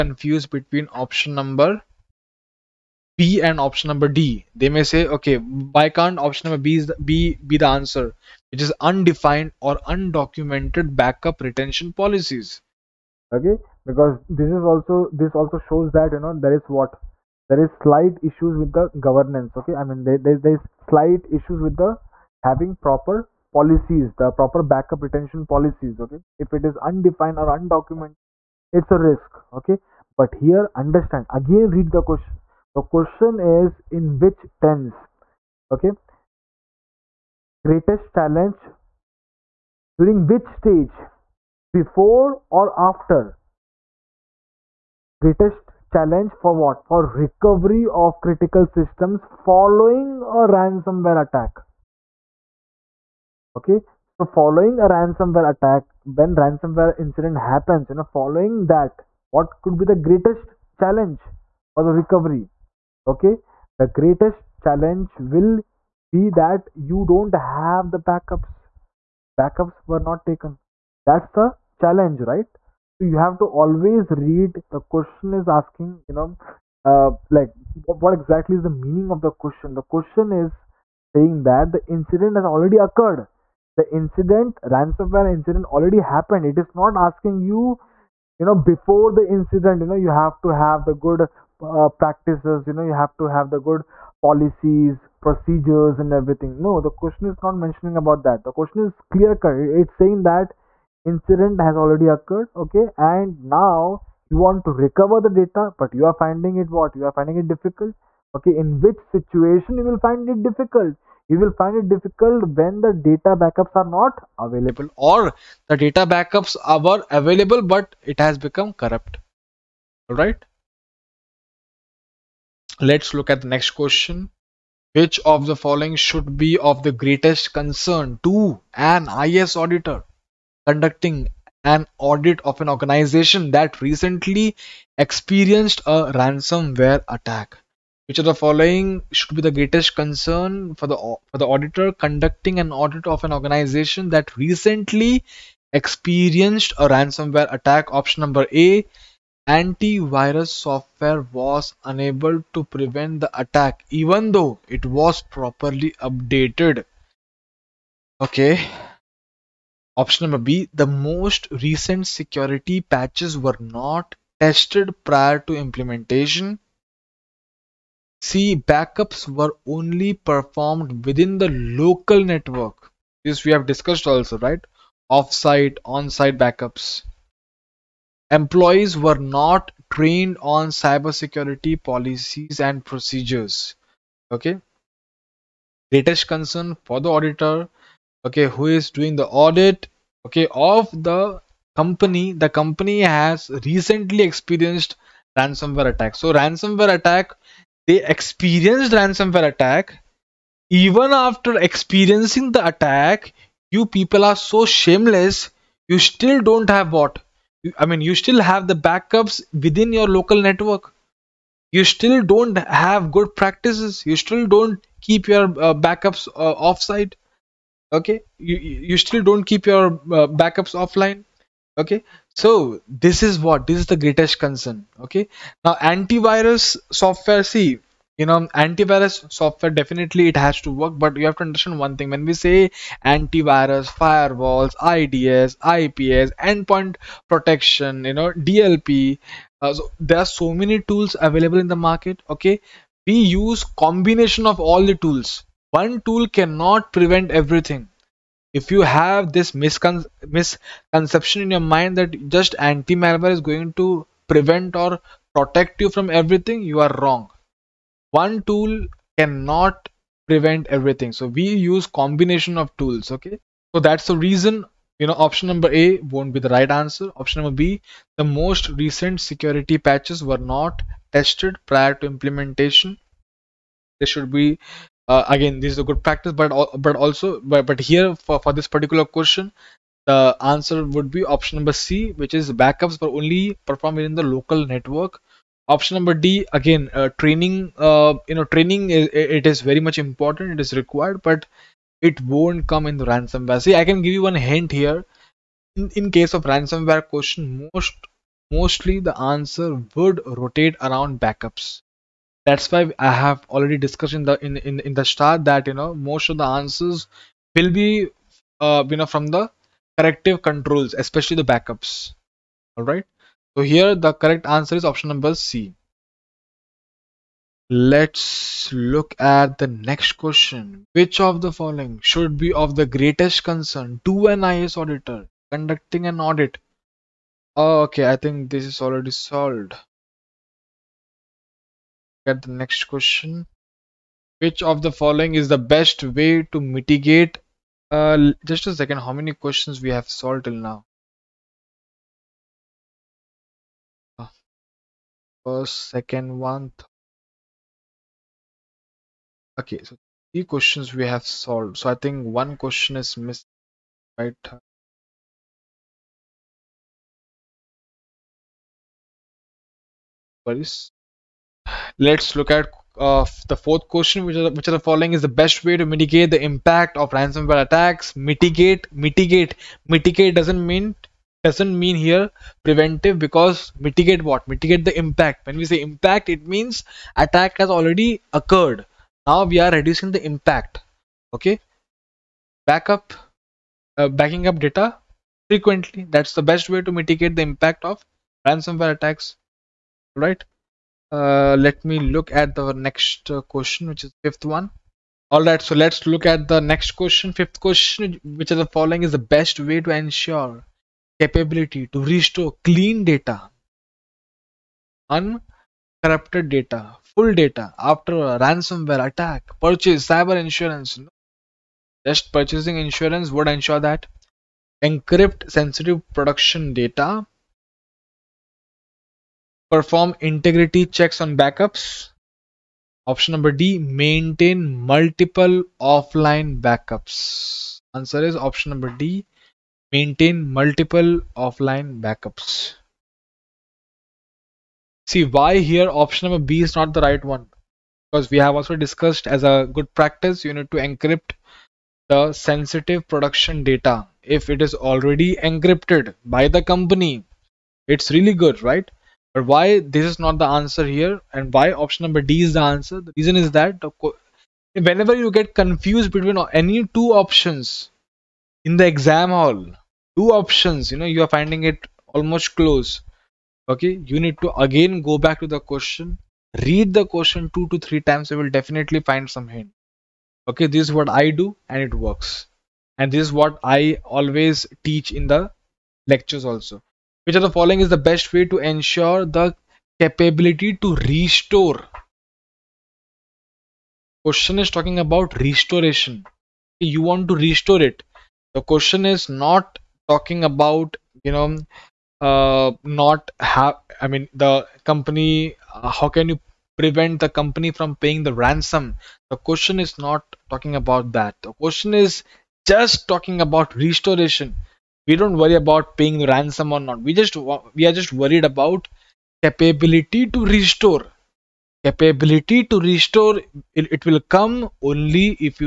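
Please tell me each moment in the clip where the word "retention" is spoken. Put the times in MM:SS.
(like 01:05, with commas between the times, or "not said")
00:11, 00:25.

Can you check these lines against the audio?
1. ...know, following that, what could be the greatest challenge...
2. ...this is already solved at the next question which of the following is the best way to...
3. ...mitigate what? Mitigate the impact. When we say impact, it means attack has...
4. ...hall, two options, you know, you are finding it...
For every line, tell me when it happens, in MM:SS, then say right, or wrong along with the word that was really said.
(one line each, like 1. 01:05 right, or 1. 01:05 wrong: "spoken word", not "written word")
1. 00:57 right
2. 05:28 right
3. 06:13 right
4. 07:39 right.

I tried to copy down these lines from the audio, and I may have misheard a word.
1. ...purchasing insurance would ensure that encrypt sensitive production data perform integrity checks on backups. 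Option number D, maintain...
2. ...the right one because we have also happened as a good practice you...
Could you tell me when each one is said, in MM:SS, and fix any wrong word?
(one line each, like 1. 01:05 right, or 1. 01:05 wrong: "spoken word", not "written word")
1. 06:52 right
2. 07:16 wrong: "discussed", not "happened".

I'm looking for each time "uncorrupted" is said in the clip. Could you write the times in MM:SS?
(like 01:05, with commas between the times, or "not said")
06:45.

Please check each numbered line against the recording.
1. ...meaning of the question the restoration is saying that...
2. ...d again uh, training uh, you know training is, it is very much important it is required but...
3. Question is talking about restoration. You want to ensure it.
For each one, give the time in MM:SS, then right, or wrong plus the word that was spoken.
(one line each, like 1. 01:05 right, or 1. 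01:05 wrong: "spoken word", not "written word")
1. 01:18 wrong: "question", not "restoration"
2. 04:46 right
3. 08:04 wrong: "restore", not "ensure".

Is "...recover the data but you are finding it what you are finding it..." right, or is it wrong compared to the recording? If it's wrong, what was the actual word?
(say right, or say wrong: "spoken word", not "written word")
right.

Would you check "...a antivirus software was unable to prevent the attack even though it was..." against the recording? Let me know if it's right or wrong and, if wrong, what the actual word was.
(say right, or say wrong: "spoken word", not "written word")
right.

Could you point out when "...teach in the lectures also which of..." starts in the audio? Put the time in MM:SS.
07:54.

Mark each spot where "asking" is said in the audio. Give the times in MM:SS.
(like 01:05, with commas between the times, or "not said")
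01:15, 01:26.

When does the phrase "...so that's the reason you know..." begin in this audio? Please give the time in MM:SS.
04:23.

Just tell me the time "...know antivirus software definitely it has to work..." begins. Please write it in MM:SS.
03:48.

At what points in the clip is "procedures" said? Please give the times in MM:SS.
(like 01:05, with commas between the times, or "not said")
01:35, 03:02.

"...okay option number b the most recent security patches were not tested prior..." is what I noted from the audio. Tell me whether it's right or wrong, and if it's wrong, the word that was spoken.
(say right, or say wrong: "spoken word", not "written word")
right.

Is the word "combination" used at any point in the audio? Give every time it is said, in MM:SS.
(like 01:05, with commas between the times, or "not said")
04:03, 04:21.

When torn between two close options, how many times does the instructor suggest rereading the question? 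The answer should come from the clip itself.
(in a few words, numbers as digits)
2 to 3 times.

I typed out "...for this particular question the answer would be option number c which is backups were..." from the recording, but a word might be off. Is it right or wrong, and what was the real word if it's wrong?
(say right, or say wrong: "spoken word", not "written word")
right.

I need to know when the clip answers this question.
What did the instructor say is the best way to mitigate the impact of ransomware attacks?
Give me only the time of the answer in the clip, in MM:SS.
06:24.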